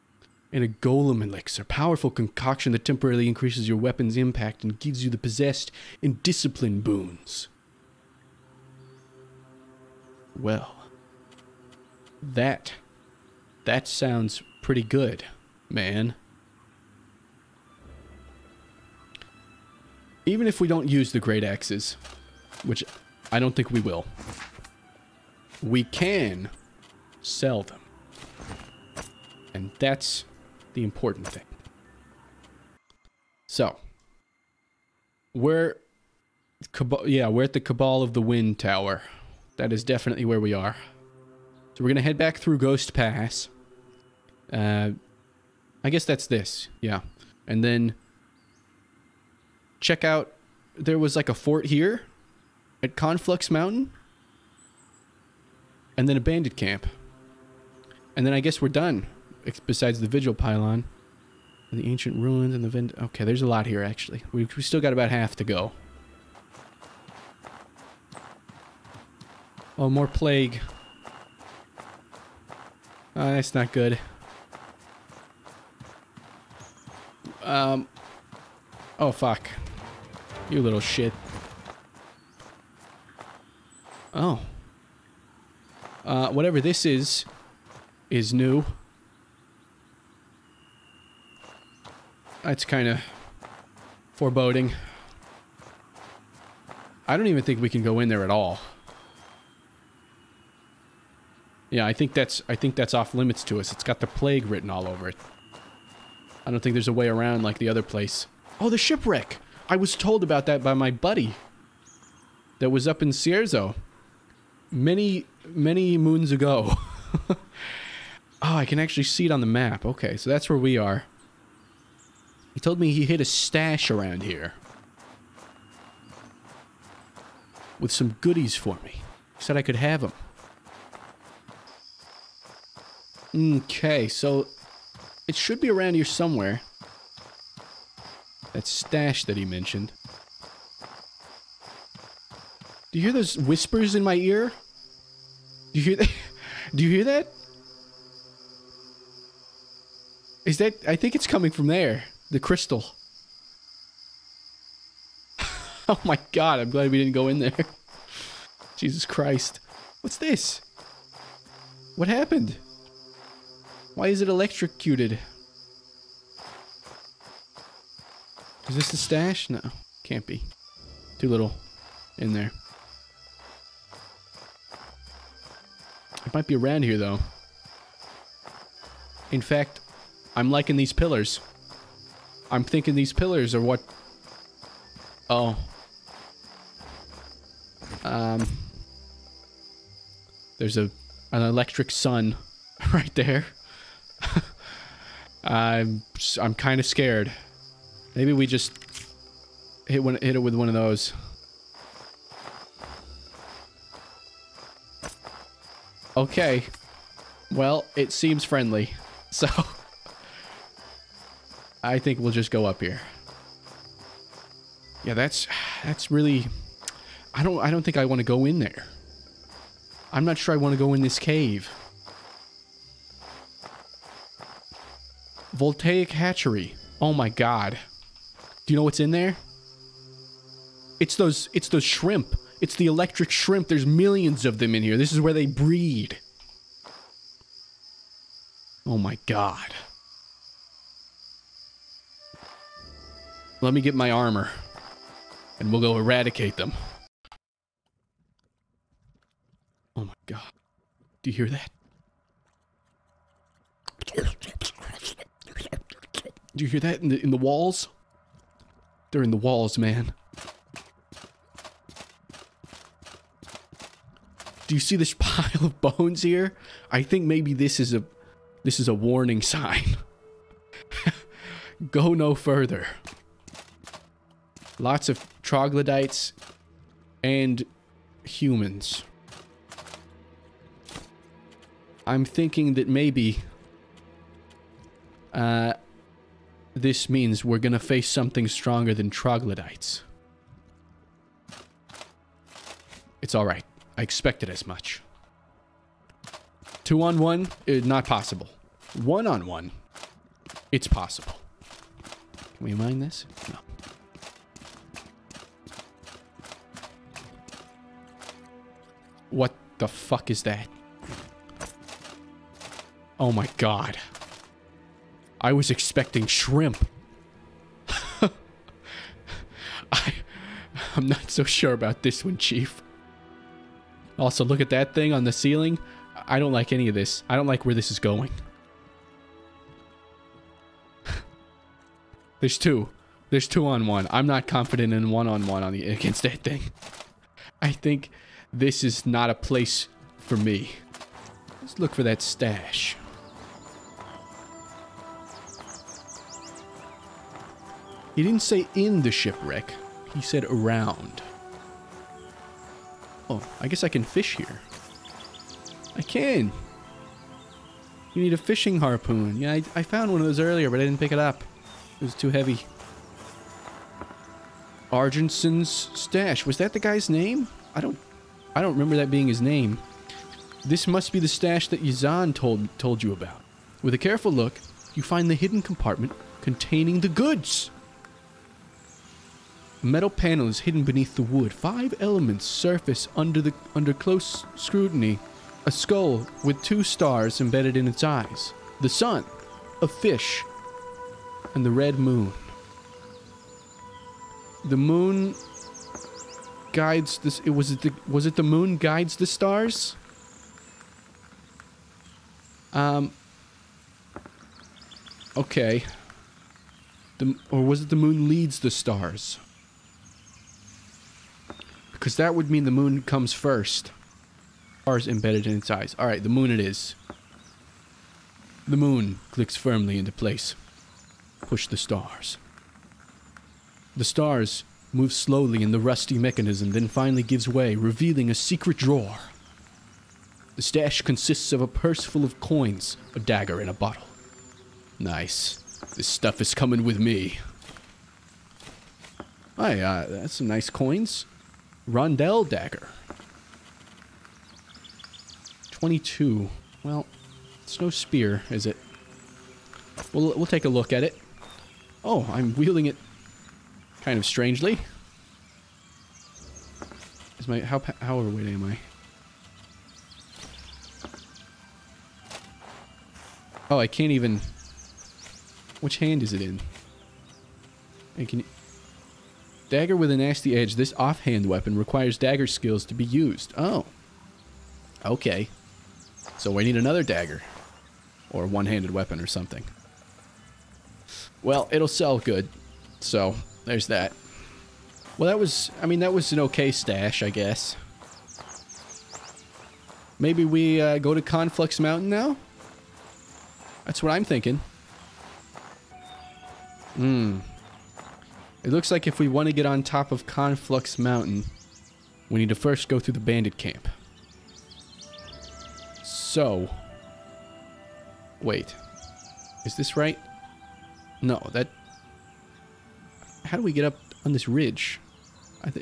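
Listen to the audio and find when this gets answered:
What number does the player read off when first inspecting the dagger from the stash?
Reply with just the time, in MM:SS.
07:25.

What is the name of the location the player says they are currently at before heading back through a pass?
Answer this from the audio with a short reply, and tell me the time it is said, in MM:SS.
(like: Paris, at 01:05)
Cabal of the Wind Tower, at 00:37.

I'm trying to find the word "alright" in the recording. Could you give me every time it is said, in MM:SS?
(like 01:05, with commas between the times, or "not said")
04:53, 06:55.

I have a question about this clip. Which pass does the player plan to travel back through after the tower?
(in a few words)
Ghost Pass.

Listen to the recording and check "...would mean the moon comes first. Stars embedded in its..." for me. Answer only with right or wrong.
right.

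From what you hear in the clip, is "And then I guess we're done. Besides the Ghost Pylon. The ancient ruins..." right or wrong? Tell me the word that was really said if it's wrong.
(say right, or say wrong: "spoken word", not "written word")
wrong: "Vigil", not "Ghost".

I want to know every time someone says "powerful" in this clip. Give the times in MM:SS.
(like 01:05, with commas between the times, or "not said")
00:01.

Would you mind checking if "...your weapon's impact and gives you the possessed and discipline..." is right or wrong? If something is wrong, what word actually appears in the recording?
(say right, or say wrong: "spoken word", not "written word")
right.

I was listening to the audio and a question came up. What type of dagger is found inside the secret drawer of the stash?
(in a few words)
Rondel dagger.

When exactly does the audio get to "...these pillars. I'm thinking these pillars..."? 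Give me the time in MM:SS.
03:00.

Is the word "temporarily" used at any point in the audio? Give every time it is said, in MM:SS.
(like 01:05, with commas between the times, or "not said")
00:02.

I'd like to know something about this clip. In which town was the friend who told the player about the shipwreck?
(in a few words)
Cierzo.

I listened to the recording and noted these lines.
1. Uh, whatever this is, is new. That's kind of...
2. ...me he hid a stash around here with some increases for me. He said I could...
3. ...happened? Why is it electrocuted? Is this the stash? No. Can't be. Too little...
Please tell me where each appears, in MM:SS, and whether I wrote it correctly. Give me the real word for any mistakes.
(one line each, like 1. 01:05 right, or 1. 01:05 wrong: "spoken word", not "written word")
1. 01:26 right
2. 02:02 wrong: "goodies", not "increases"
3. 02:42 right.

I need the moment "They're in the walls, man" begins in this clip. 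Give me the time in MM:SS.
04:19.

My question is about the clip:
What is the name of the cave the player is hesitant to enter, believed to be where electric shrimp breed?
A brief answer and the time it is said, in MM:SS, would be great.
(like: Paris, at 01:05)
Voltaic hatchery, at 03:45.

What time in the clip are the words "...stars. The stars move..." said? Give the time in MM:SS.
07:01.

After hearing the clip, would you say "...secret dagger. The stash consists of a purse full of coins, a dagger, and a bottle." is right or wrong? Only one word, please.
wrong.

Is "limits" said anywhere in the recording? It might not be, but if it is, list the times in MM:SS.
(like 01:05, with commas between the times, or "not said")
01:43.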